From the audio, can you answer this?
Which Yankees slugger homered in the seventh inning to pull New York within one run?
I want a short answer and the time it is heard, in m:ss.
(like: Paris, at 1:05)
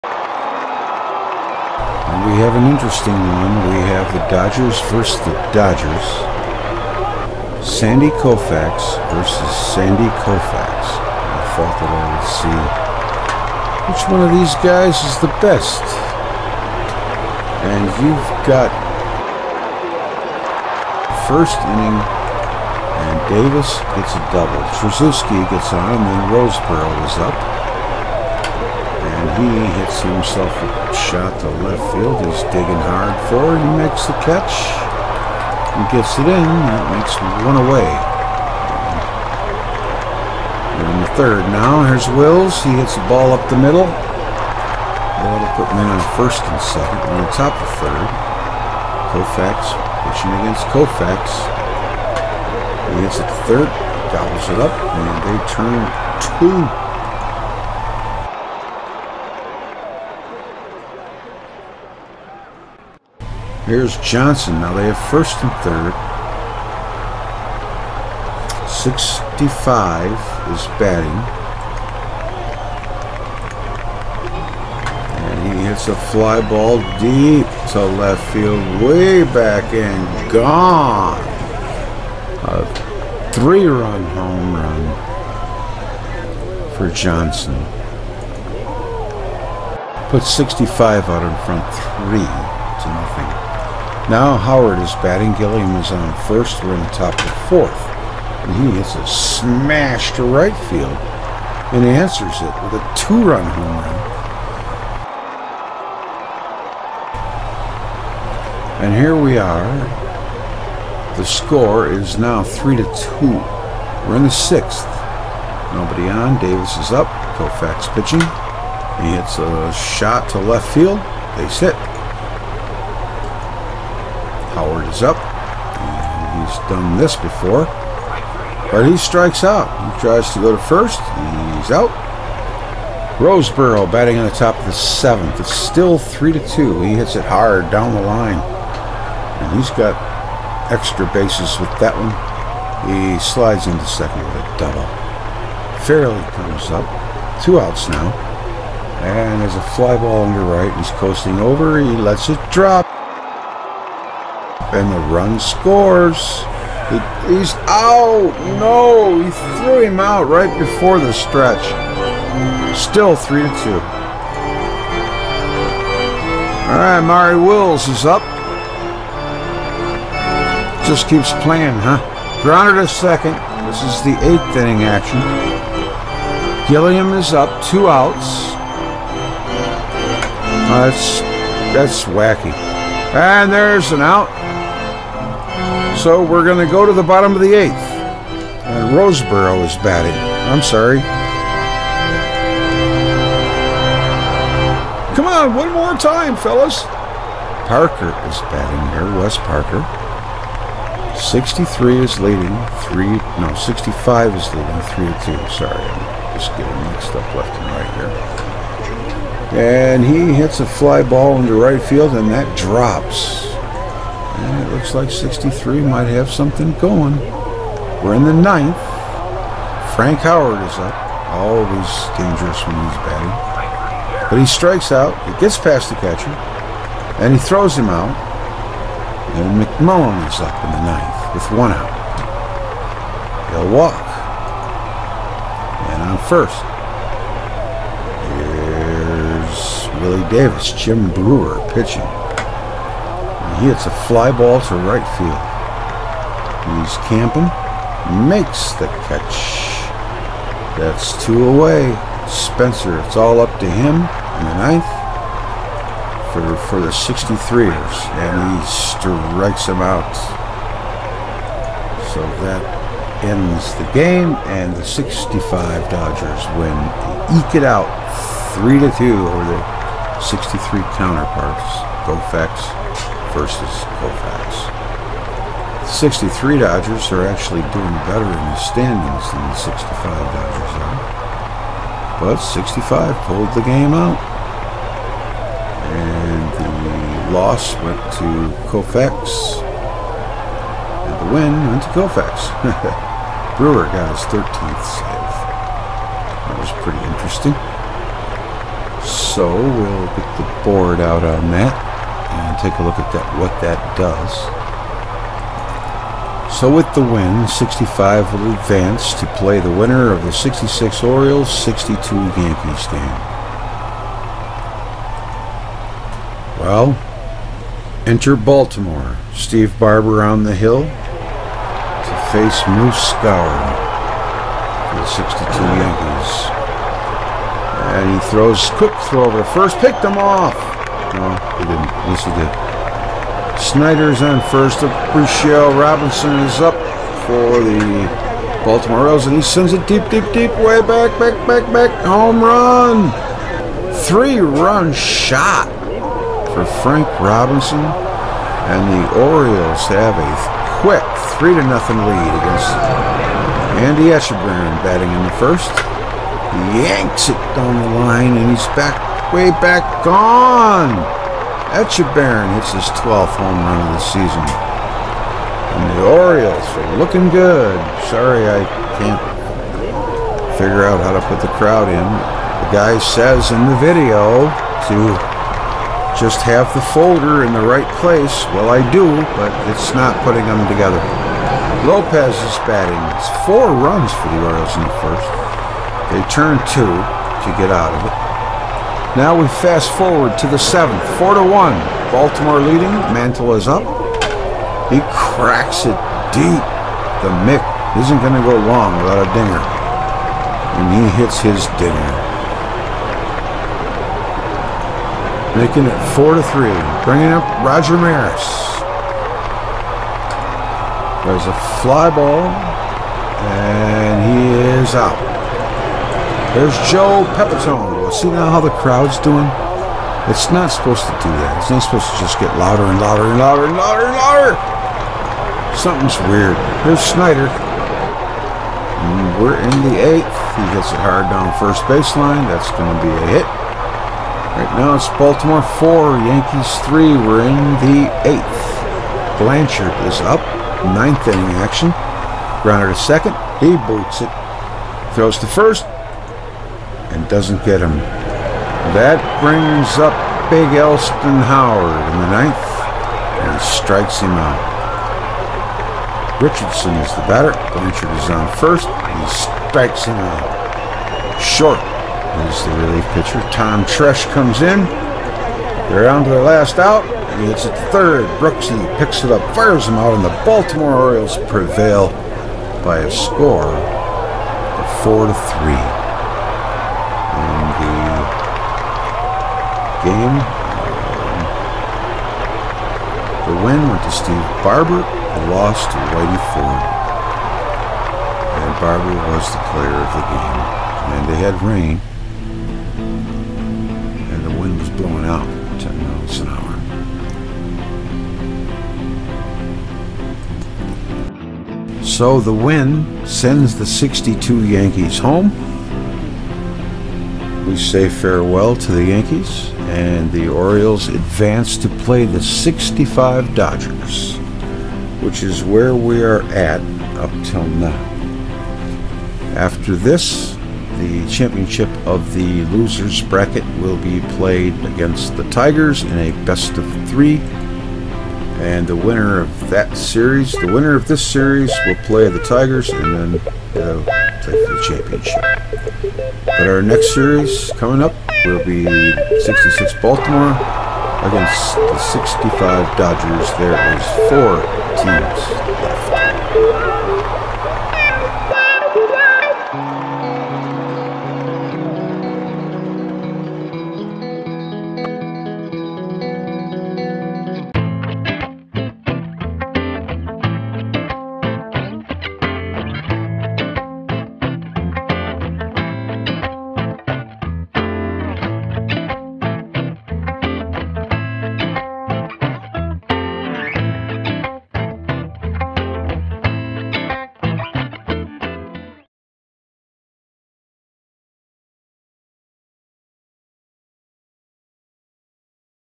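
Mantle, at 6:33.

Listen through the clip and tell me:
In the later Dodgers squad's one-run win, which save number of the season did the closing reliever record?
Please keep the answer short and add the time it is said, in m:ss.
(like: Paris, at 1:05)
13th, at 4:53.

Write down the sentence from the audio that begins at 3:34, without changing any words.
And it looks like 63 might have something going.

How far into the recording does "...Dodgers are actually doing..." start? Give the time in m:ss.
4:36.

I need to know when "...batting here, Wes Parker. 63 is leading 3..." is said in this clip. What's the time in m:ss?
3:18.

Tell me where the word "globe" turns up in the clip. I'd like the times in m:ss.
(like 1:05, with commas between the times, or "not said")
not said.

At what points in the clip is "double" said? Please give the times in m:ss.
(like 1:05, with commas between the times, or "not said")
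0:24, 2:24.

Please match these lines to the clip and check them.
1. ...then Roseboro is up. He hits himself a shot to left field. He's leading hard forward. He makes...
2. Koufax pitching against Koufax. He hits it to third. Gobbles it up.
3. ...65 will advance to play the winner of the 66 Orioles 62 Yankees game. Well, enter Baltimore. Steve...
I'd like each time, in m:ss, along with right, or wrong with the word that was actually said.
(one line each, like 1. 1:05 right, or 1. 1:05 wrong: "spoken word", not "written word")
1. 0:26 wrong: "digging", not "leading"
2. 0:49 right
3. 5:07 right.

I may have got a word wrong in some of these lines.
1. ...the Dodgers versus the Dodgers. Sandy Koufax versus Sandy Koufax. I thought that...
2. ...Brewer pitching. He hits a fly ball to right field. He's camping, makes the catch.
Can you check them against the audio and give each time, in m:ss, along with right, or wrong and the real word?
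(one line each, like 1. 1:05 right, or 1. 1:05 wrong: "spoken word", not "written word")
1. 0:04 right
2. 4:01 right.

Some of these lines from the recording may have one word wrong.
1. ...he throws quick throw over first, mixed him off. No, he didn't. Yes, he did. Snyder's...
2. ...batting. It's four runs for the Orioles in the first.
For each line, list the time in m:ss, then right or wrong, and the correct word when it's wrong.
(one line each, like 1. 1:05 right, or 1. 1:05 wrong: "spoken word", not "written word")
1. 5:28 wrong: "picked", not "mixed"
2. 6:22 right.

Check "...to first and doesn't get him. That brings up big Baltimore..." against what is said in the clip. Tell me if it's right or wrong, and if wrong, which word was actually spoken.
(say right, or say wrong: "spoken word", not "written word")
wrong: "Elston", not "Baltimore".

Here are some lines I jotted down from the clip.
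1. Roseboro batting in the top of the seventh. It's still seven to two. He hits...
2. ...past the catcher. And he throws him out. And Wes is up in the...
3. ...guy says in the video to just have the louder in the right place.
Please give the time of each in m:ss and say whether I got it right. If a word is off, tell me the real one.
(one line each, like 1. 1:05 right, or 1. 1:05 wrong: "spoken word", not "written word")
1. 2:13 wrong: "three", not "seven"
2. 3:45 wrong: "McMullen", not "Wes"
3. 6:12 wrong: "folder", not "louder".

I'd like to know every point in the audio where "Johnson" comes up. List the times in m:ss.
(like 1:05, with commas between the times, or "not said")
1:03, 1:26.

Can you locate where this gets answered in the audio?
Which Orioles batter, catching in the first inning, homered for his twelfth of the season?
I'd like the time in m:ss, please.
5:53.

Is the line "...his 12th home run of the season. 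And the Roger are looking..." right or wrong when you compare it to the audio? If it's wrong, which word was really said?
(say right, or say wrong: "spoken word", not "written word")
wrong: "Orioles", not "Roger".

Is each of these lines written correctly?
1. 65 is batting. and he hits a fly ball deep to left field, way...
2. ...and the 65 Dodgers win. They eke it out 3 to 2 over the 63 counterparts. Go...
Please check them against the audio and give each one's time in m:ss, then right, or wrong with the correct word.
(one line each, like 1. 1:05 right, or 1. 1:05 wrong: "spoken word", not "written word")
1. 1:08 right
2. 4:24 right.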